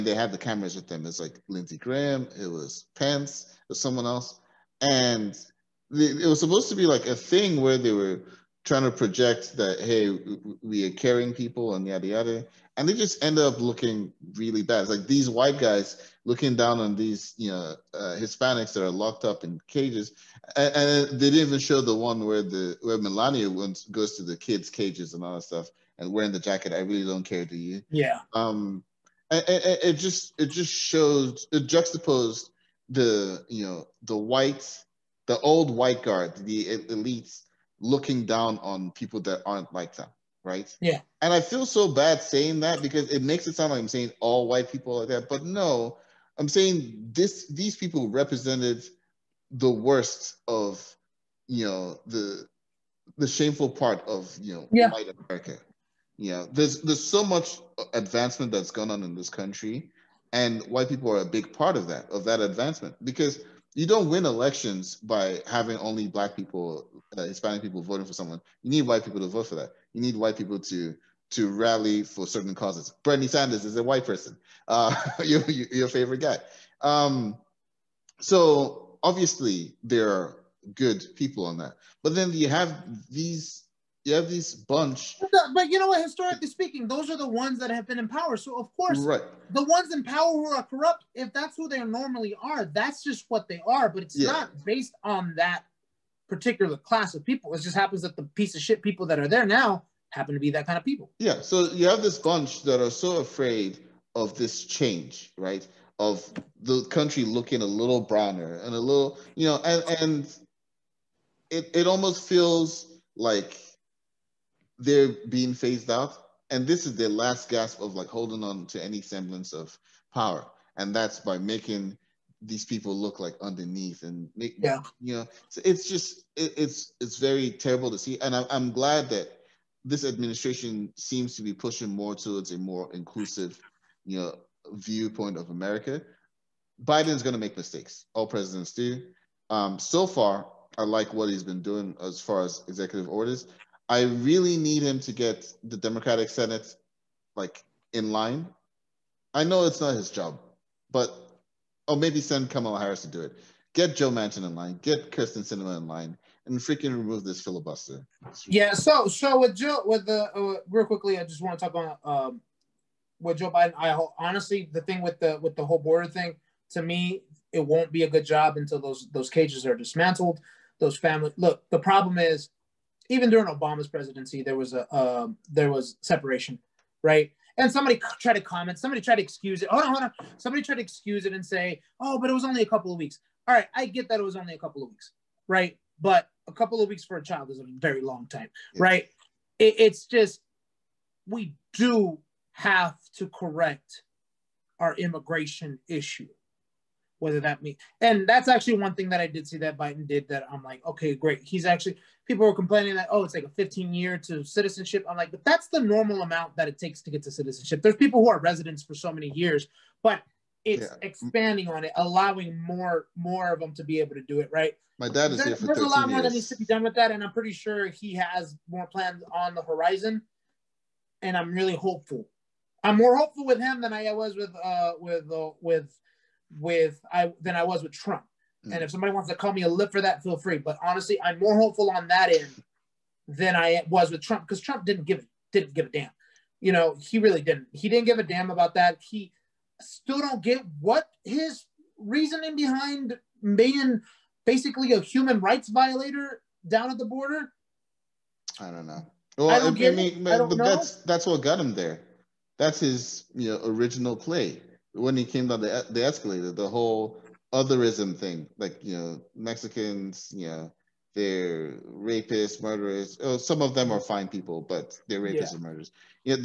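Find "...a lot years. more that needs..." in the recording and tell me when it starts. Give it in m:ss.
3:35.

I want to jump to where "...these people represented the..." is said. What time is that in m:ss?
0:47.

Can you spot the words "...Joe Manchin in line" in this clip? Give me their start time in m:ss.
2:33.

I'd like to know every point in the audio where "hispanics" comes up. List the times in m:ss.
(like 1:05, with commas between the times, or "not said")
0:18, 1:07.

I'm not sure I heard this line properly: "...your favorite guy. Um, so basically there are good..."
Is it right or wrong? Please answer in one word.
wrong.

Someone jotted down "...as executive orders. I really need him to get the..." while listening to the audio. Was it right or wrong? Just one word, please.
right.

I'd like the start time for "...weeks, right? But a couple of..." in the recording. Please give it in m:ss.
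3:04.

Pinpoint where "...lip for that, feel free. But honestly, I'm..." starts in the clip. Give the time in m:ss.
3:49.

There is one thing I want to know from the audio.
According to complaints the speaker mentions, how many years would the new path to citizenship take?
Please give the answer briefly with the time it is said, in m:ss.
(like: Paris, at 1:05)
15 years, at 3:23.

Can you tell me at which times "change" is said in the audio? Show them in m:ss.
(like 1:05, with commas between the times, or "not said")
1:44.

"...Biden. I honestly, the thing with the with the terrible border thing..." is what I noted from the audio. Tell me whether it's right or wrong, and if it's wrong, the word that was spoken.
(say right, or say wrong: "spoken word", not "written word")
wrong: "whole", not "terrible".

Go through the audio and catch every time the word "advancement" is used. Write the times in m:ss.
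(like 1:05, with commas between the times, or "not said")
0:57, 1:02.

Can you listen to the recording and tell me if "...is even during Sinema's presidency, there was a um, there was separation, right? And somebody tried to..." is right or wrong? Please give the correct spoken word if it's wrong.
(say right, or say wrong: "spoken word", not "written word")
wrong: "Obama", not "Sinema".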